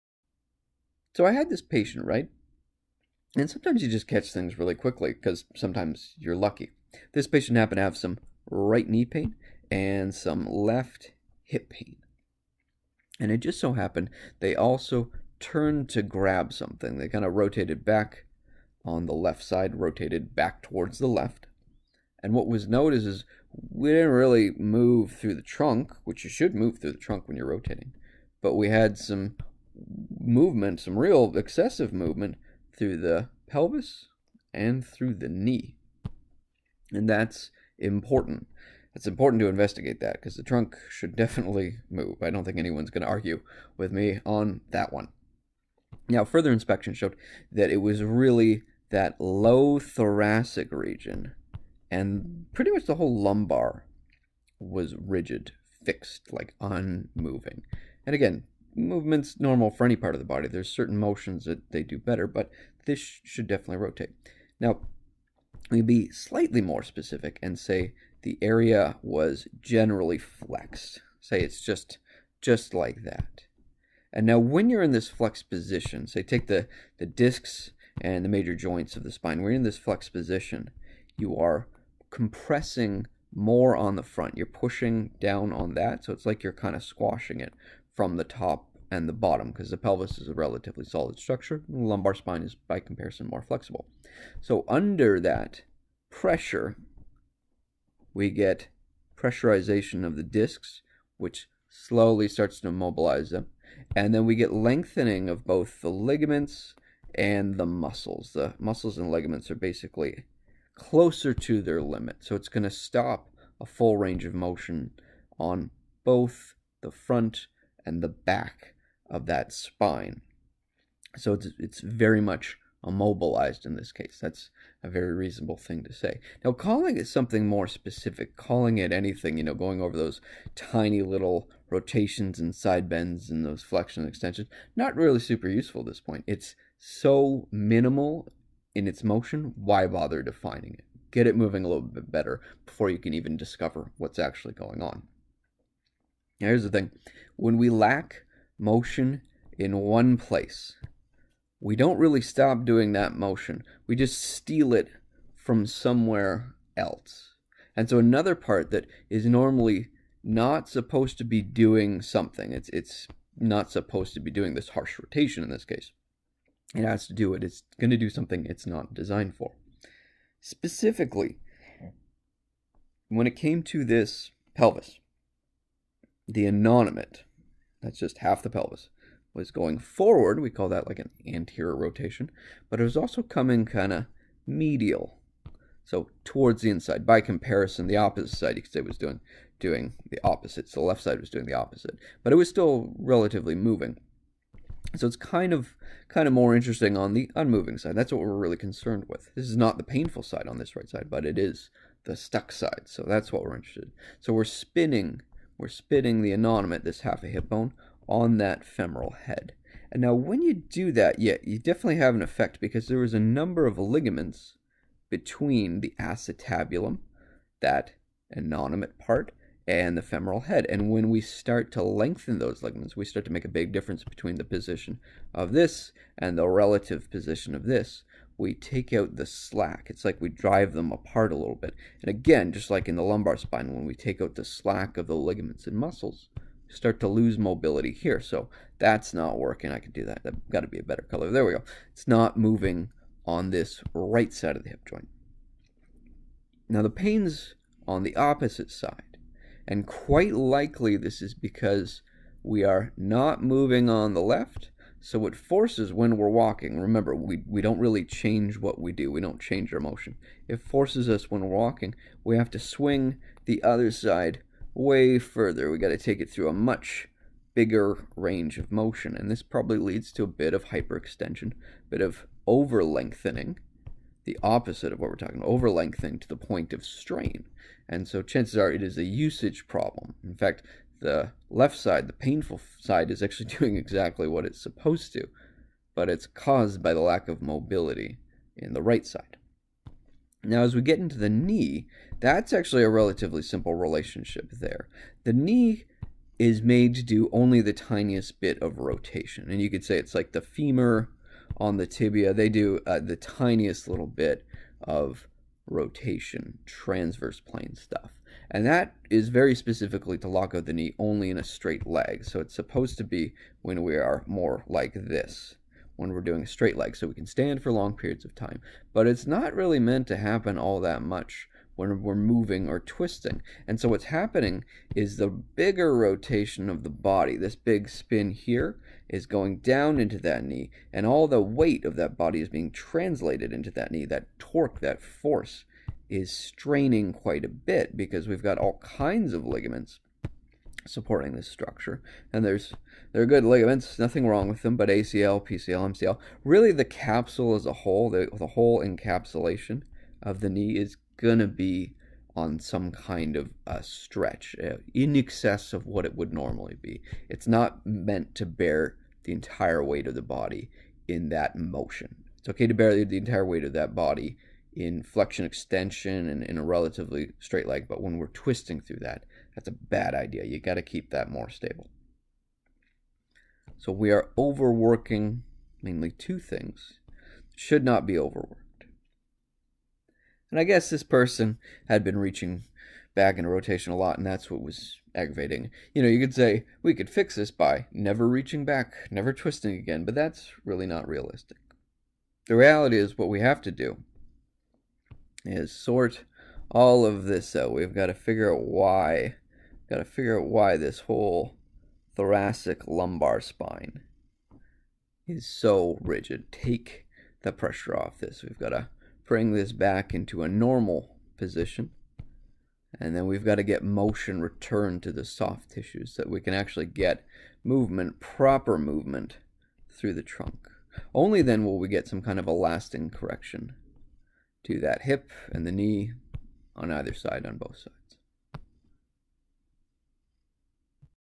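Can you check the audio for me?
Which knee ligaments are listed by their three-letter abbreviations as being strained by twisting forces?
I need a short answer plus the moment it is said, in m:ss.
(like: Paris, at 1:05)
ACL, PCL, MCL, at 5:44.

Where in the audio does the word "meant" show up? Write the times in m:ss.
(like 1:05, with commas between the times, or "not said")
5:19, 5:57.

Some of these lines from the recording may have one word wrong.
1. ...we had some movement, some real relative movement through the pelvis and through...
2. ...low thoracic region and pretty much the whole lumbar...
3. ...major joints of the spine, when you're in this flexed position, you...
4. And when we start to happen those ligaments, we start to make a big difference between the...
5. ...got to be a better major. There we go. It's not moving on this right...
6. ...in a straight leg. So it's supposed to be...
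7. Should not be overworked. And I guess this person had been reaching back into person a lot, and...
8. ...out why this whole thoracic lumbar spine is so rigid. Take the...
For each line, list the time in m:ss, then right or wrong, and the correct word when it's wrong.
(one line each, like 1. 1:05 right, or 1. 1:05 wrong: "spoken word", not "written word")
1. 0:28 wrong: "excessive", not "relative"
2. 0:49 right
3. 1:18 right
4. 3:40 wrong: "lengthen", not "happen"
5. 4:00 wrong: "color", not "major"
6. 5:11 right
7. 6:17 wrong: "rotation", not "person"
8. 6:40 right.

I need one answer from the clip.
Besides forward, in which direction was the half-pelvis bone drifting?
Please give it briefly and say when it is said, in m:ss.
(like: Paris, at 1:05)
Medial, at 3:04.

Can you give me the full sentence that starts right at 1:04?
Now, we'd be slightly more specific and say the area was generally flexed.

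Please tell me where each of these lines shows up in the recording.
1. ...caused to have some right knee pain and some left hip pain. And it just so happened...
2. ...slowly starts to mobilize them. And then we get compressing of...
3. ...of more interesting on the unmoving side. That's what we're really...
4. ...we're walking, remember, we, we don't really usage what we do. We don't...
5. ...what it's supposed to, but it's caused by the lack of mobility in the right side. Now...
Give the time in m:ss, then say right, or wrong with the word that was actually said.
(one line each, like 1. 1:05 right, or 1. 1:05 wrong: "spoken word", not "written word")
1. 0:07 wrong: "happened", not "caused"
2. 1:41 wrong: "lengthening", not "compressing"
3. 3:16 right
4. 4:16 wrong: "change", not "usage"
5. 4:44 right.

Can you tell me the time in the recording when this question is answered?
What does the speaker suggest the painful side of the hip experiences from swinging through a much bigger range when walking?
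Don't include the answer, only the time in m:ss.
4:30.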